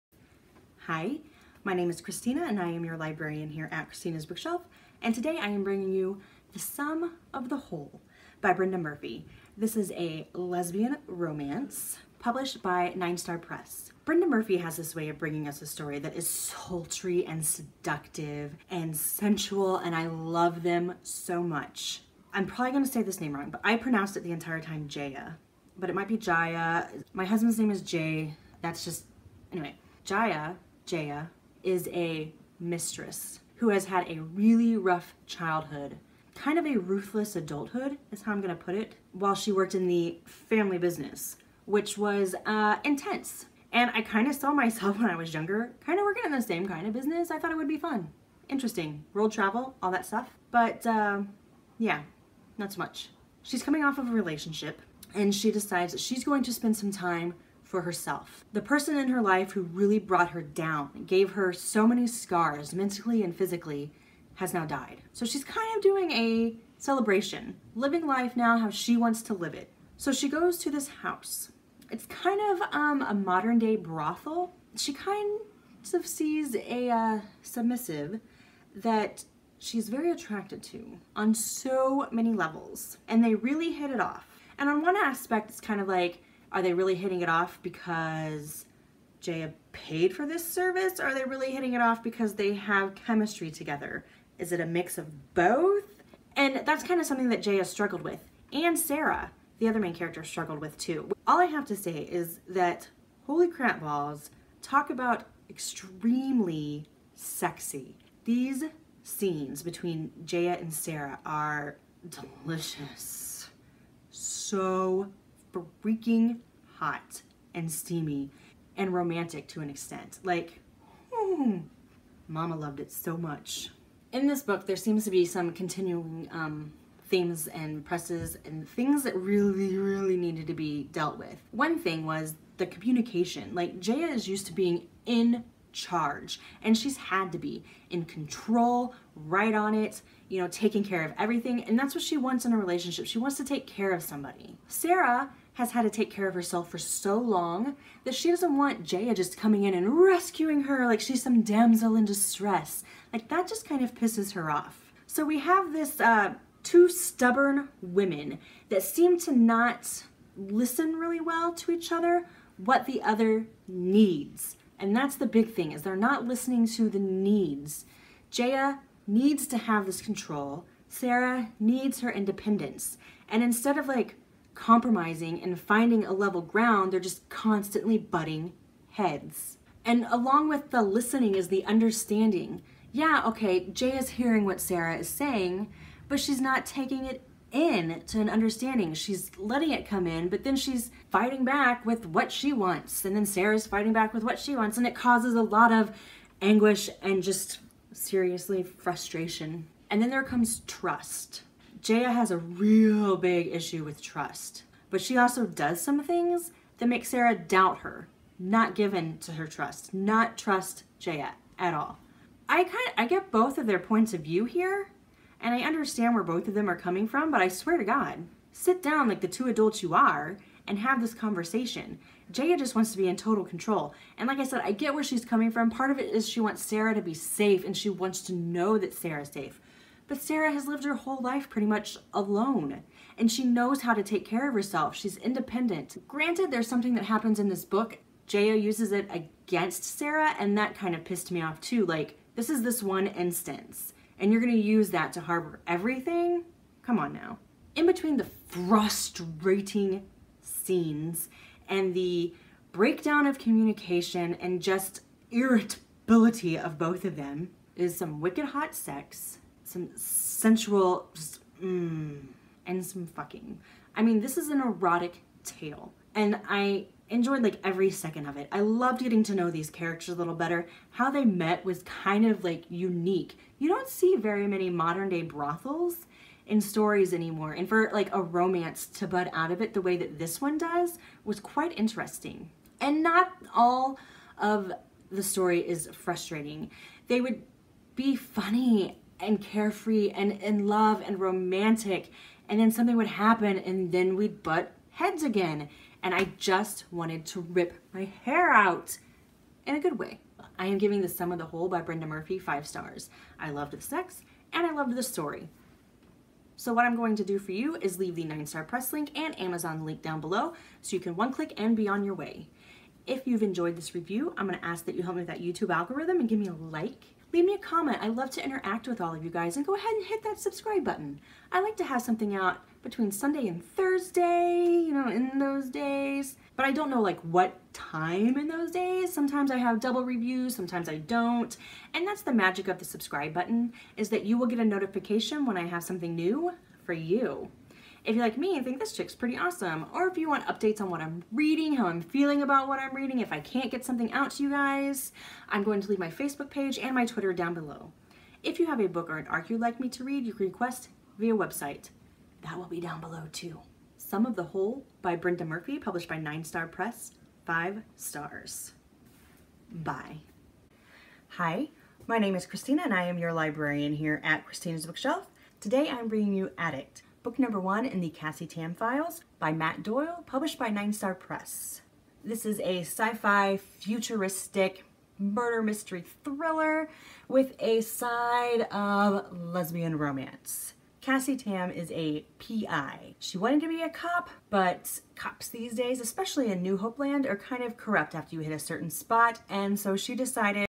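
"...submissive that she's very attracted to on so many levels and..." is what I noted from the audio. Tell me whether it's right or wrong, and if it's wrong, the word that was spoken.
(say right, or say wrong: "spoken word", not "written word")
right.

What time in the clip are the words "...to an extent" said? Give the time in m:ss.
1:59.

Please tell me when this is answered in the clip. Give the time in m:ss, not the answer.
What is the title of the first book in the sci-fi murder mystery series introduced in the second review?
6:06.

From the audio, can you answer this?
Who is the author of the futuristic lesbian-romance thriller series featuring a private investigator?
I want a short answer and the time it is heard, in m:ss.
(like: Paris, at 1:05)
Matt Doyle, at 6:09.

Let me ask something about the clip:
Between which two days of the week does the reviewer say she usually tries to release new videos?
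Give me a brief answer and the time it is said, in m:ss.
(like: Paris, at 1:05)
Sunday and Thursday, at 5:23.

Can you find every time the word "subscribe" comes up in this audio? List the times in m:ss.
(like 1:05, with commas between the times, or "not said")
5:20, 5:32.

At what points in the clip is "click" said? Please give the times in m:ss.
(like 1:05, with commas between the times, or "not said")
5:11.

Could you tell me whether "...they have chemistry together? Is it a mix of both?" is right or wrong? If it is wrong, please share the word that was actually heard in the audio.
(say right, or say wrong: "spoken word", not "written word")
right.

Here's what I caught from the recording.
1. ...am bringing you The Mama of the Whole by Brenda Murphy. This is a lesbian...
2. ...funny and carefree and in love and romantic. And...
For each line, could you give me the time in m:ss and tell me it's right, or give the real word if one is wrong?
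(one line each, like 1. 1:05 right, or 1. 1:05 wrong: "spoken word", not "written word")
1. 0:05 wrong: "Sum", not "Mama"
2. 4:48 right.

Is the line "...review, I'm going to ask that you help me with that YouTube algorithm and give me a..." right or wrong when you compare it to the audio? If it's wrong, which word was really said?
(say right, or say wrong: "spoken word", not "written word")
right.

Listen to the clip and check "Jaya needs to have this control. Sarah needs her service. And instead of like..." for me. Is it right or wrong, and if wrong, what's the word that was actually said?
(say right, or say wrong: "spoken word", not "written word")
wrong: "independence", not "service".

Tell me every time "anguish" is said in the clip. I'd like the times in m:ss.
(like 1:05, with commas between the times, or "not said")
3:16.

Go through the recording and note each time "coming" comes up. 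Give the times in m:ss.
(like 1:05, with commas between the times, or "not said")
0:53, 2:29, 3:36, 3:45.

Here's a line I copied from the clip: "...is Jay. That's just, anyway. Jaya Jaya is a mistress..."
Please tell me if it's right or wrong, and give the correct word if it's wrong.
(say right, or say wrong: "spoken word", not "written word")
right.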